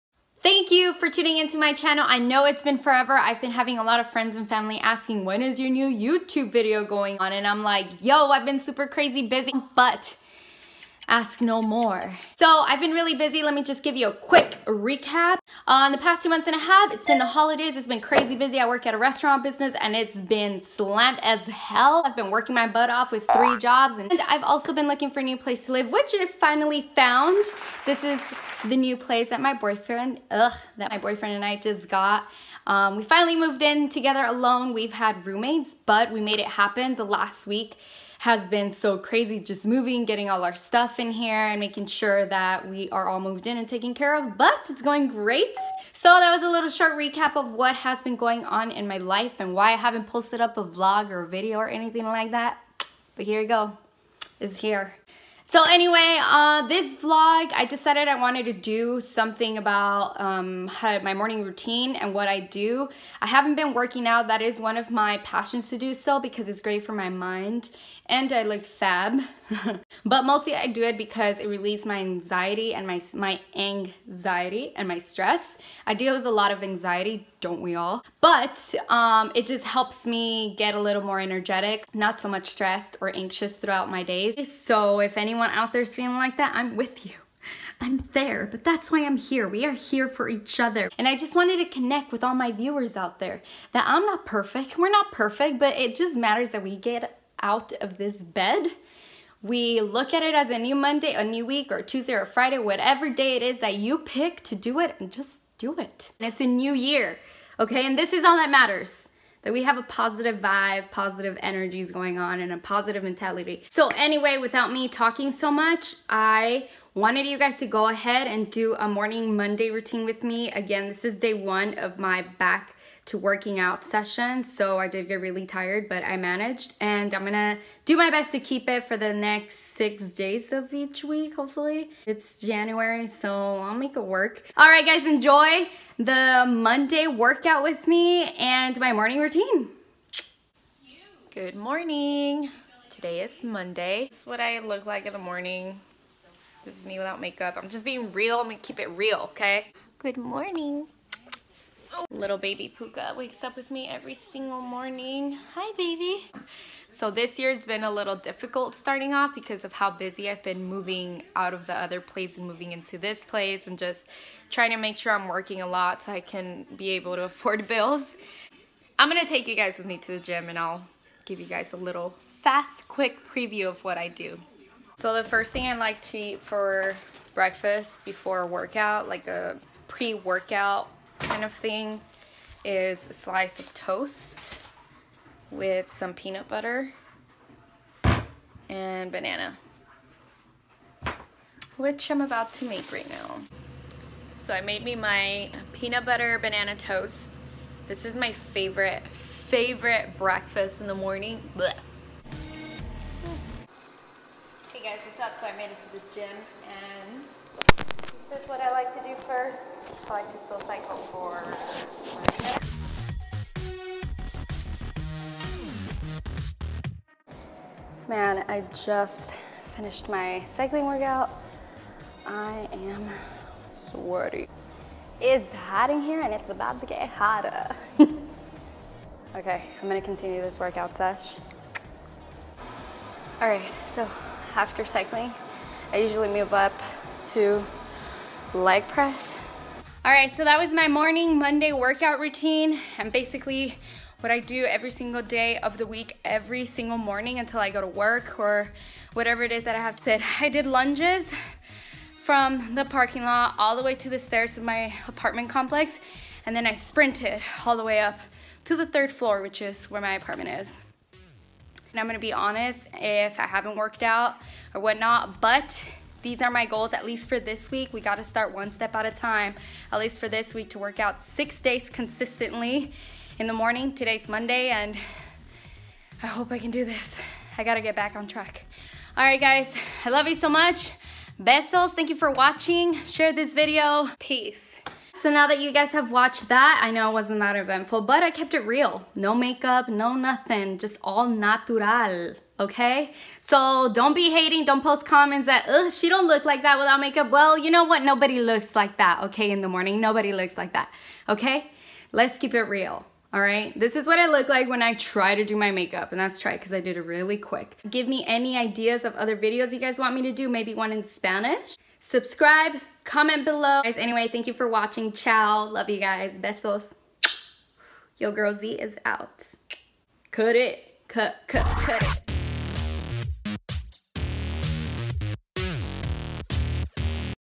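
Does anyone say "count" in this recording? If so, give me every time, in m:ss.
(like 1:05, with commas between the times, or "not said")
not said.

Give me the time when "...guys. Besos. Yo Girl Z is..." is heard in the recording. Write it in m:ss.
5:15.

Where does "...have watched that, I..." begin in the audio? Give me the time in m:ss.
4:45.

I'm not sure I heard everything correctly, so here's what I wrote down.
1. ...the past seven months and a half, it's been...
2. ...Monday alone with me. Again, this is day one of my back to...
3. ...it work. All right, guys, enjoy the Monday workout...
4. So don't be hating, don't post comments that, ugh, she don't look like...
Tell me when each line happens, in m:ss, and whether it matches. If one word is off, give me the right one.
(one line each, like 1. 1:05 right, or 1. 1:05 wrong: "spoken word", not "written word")
1. 0:15 wrong: "two", not "seven"
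2. 1:59 wrong: "routine", not "alone"
3. 2:13 right
4. 4:53 right.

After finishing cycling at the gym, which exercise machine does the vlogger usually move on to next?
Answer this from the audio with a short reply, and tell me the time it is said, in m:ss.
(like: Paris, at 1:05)
Leg press, at 3:58.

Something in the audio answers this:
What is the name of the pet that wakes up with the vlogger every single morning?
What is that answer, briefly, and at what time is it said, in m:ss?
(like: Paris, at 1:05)
Puka, at 2:32.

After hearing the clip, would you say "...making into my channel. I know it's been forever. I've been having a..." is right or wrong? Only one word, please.
wrong.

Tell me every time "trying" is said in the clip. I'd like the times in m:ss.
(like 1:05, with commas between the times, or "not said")
2:44.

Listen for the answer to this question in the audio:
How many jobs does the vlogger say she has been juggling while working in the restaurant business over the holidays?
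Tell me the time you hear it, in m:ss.
0:23.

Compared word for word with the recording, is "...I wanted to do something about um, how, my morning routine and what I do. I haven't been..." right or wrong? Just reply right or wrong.
right.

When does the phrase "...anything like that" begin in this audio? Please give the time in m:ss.
0:51.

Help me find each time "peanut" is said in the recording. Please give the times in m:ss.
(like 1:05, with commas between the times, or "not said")
3:06, 3:15.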